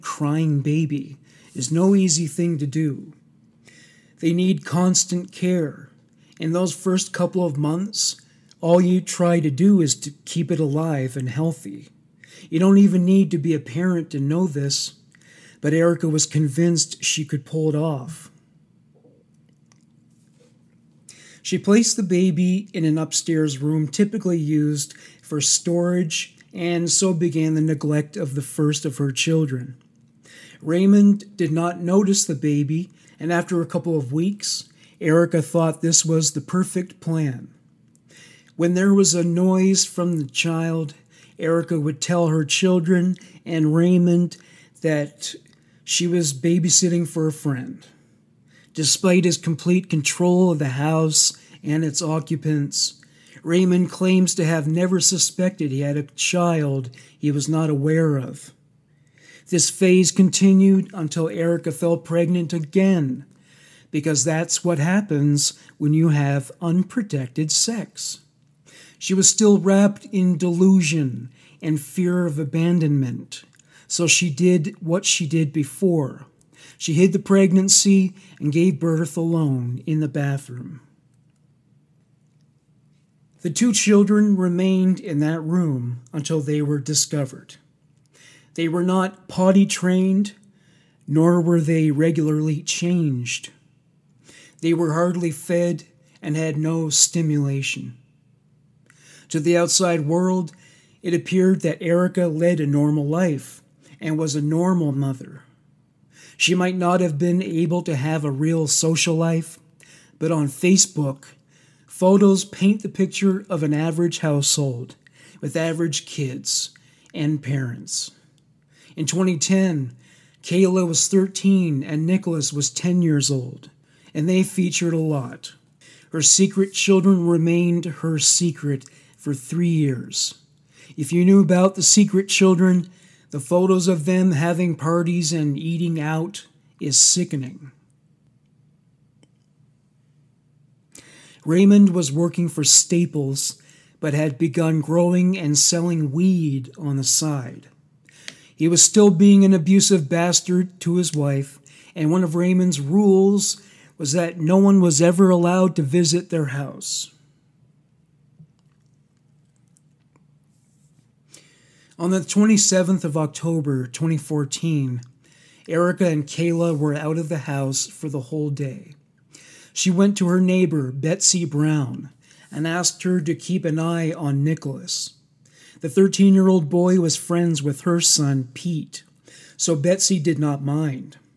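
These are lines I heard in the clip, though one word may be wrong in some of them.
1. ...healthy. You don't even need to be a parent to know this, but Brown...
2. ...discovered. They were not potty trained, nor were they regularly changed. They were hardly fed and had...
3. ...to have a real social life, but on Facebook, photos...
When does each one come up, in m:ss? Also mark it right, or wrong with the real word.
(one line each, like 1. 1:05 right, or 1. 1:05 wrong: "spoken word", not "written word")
1. 0:11 wrong: "Erica", not "Brown"
2. 1:26 right
3. 1:47 right.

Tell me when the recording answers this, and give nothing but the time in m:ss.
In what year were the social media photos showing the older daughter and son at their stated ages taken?
1:59.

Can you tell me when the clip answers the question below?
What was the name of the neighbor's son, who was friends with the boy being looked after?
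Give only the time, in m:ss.
2:58.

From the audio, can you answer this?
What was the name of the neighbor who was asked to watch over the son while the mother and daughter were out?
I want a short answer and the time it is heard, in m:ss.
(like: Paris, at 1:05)
Betsy Brown, at 2:50.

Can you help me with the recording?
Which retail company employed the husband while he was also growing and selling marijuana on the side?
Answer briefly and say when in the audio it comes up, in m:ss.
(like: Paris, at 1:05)
Staples, at 2:22.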